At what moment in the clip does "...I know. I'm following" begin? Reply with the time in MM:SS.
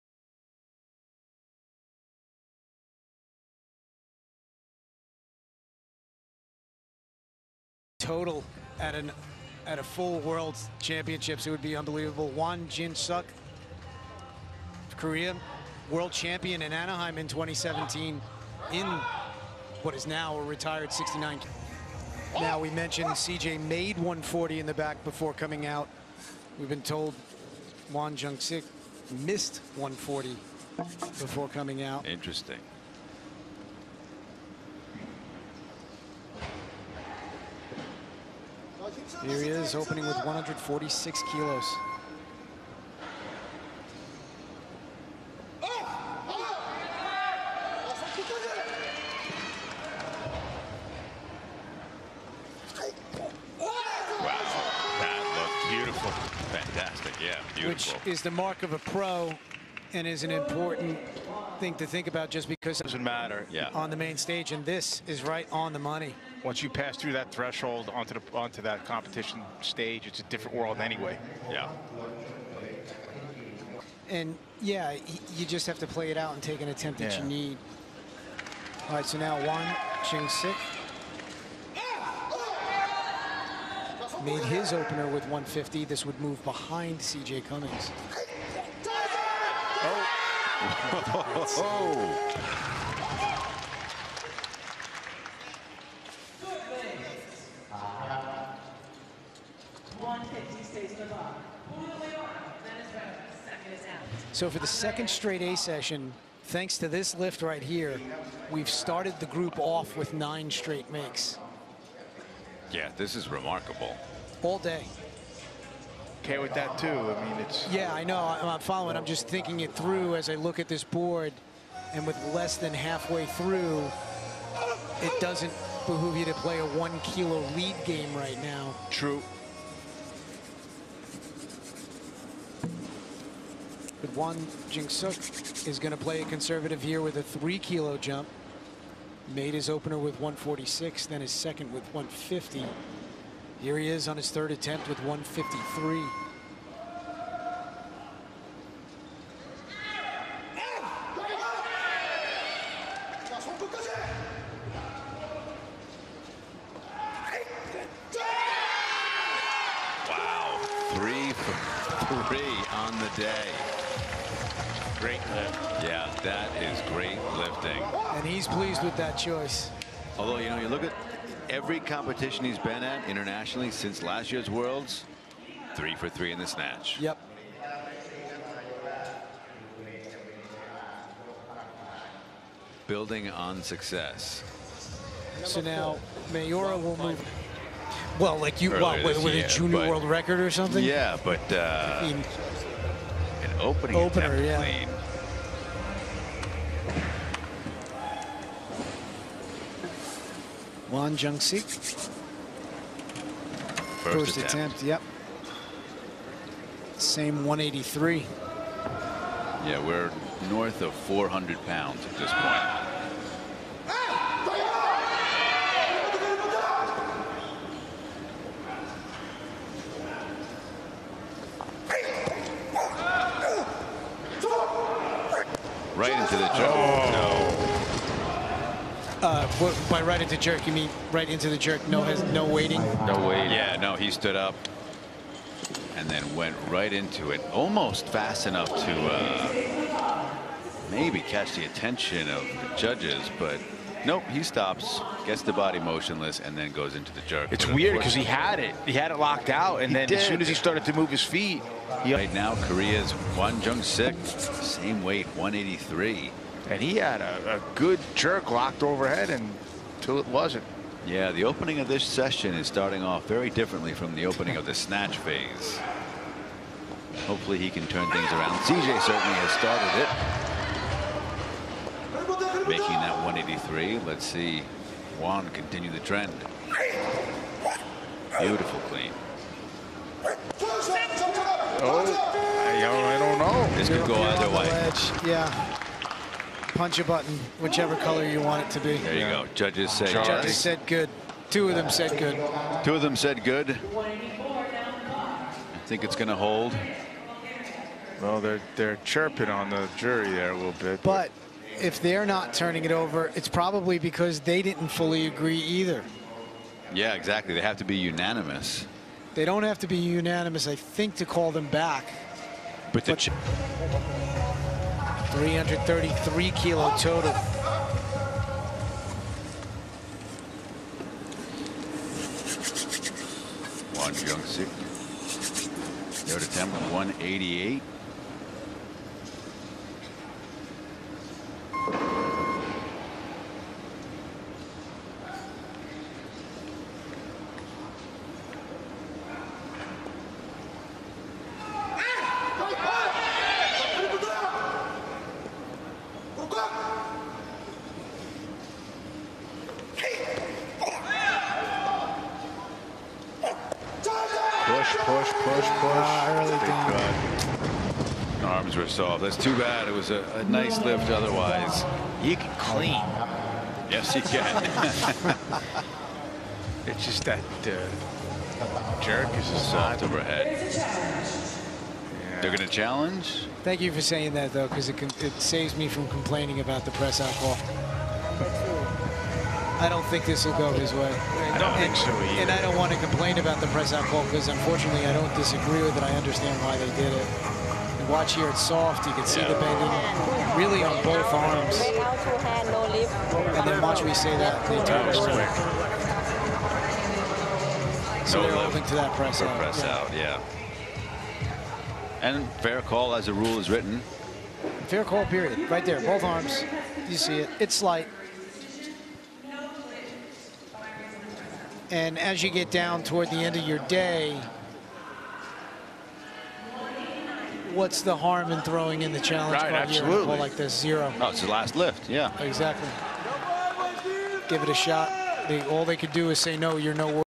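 01:57.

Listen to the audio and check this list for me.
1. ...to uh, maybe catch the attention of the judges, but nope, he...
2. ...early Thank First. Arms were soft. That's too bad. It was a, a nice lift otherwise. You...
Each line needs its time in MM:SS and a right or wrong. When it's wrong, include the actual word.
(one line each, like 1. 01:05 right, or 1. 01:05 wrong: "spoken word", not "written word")
1. 03:58 right
2. 05:56 wrong: "God", not "First".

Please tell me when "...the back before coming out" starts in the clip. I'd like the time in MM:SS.
00:24.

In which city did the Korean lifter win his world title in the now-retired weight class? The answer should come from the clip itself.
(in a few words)
Anaheim.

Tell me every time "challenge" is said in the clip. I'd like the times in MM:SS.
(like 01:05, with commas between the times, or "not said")
06:12, 06:59.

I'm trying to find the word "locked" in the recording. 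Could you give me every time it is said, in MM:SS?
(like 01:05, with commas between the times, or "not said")
04:09, 04:18.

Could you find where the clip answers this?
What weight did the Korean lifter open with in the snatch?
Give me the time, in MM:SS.
00:40.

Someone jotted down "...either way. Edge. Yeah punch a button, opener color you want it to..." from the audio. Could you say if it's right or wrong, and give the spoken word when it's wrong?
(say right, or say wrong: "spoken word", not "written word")
wrong: "whichever", not "opener".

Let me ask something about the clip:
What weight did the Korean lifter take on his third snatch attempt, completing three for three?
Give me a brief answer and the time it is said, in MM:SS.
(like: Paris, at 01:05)
153, at 02:25.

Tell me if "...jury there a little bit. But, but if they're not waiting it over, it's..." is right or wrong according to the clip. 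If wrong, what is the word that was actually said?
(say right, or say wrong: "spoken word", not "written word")
wrong: "turning", not "waiting".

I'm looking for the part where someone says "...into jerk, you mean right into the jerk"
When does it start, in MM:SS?
03:50.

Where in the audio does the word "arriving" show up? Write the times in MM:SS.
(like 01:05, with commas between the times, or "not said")
not said.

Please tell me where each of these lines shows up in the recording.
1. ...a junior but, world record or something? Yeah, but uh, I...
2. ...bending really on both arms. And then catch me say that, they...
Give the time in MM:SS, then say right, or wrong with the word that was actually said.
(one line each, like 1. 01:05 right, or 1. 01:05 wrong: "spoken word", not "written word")
1. 03:09 right
2. 06:29 wrong: "watch", not "catch".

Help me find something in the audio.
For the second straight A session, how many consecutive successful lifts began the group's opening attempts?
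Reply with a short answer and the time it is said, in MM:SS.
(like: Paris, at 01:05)
9, at 01:50.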